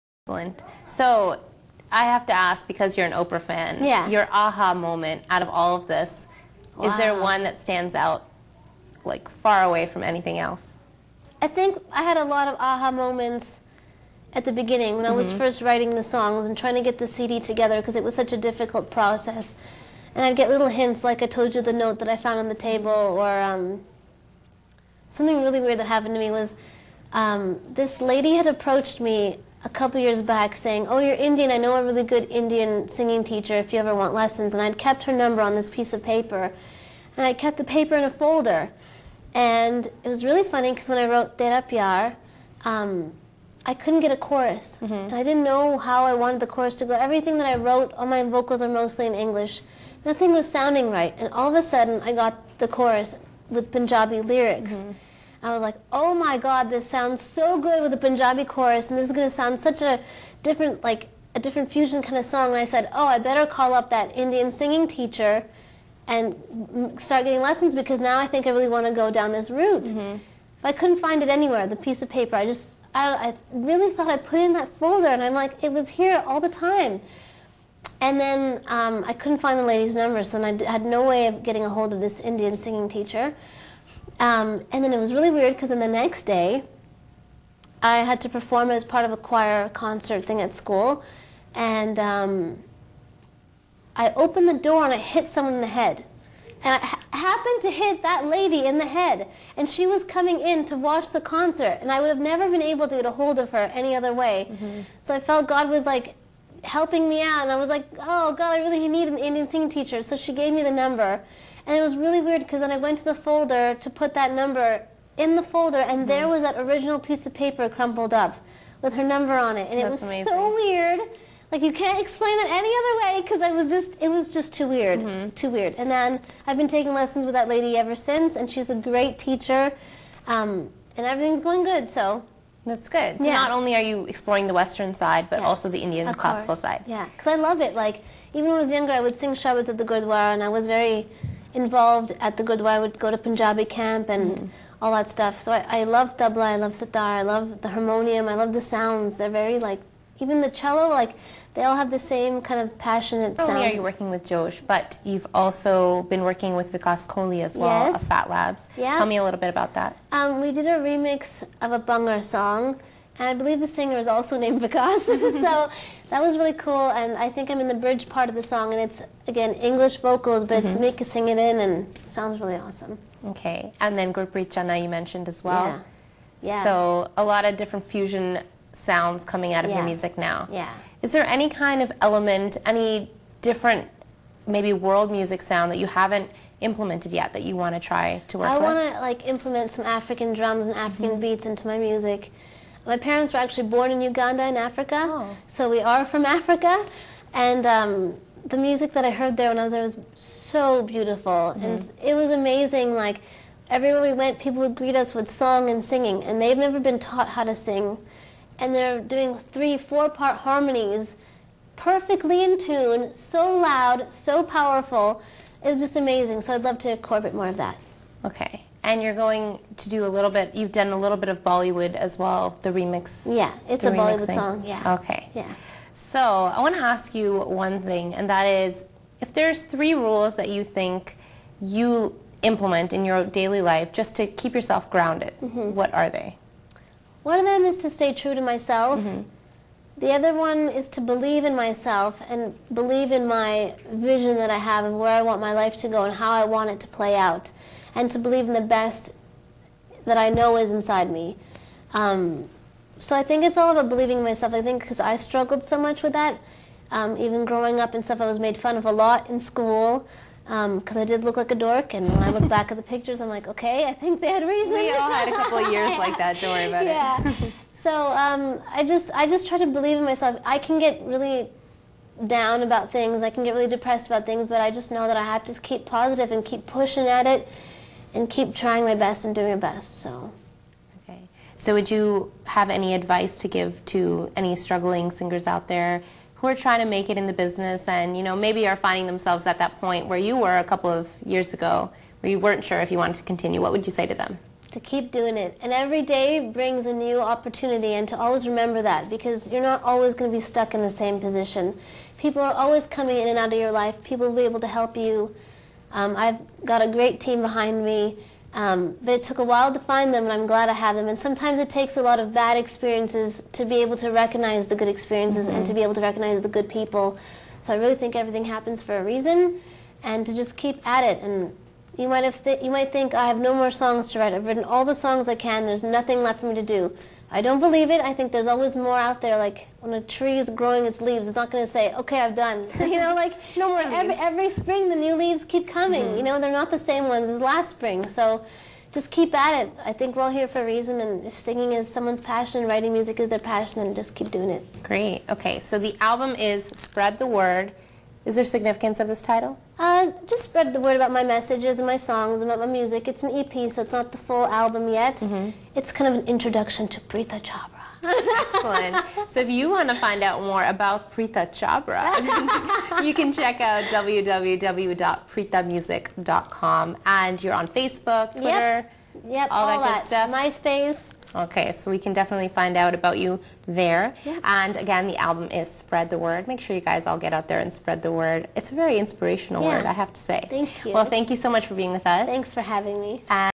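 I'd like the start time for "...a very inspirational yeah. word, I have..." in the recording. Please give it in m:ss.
6:18.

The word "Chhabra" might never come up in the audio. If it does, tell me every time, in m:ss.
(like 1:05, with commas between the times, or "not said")
5:57, 6:01.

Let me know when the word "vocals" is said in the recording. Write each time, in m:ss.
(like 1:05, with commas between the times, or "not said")
0:48, 2:49.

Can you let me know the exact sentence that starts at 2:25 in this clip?
So I, I love tabla, I love sitar, I love the harmonium, I love the sounds.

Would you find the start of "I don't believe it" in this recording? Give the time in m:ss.
5:27.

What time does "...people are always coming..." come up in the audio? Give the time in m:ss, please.
5:02.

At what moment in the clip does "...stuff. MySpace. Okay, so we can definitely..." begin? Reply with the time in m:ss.
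6:10.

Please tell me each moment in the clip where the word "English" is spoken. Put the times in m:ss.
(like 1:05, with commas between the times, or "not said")
0:49, 2:49.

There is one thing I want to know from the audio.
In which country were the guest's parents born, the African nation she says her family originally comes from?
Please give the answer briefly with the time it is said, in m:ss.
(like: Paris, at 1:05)
Uganda, at 3:14.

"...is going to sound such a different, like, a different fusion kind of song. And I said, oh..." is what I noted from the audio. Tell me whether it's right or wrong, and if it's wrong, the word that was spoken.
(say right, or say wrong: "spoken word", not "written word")
right.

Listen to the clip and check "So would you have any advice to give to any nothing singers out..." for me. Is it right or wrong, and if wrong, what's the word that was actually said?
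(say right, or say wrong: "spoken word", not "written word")
wrong: "struggling", not "nothing".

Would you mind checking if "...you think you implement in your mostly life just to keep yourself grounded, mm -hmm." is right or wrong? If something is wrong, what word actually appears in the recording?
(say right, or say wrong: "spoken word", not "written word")
wrong: "daily", not "mostly".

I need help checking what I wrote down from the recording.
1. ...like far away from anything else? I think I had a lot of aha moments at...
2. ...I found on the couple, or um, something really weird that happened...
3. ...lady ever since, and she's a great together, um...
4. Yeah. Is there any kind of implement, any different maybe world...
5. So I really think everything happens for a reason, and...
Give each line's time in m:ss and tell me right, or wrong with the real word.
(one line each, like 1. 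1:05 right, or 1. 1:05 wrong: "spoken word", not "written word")
1. 0:09 right
2. 0:22 wrong: "table", not "couple"
3. 2:07 wrong: "teacher", not "together"
4. 3:00 wrong: "element", not "implement"
5. 5:17 right.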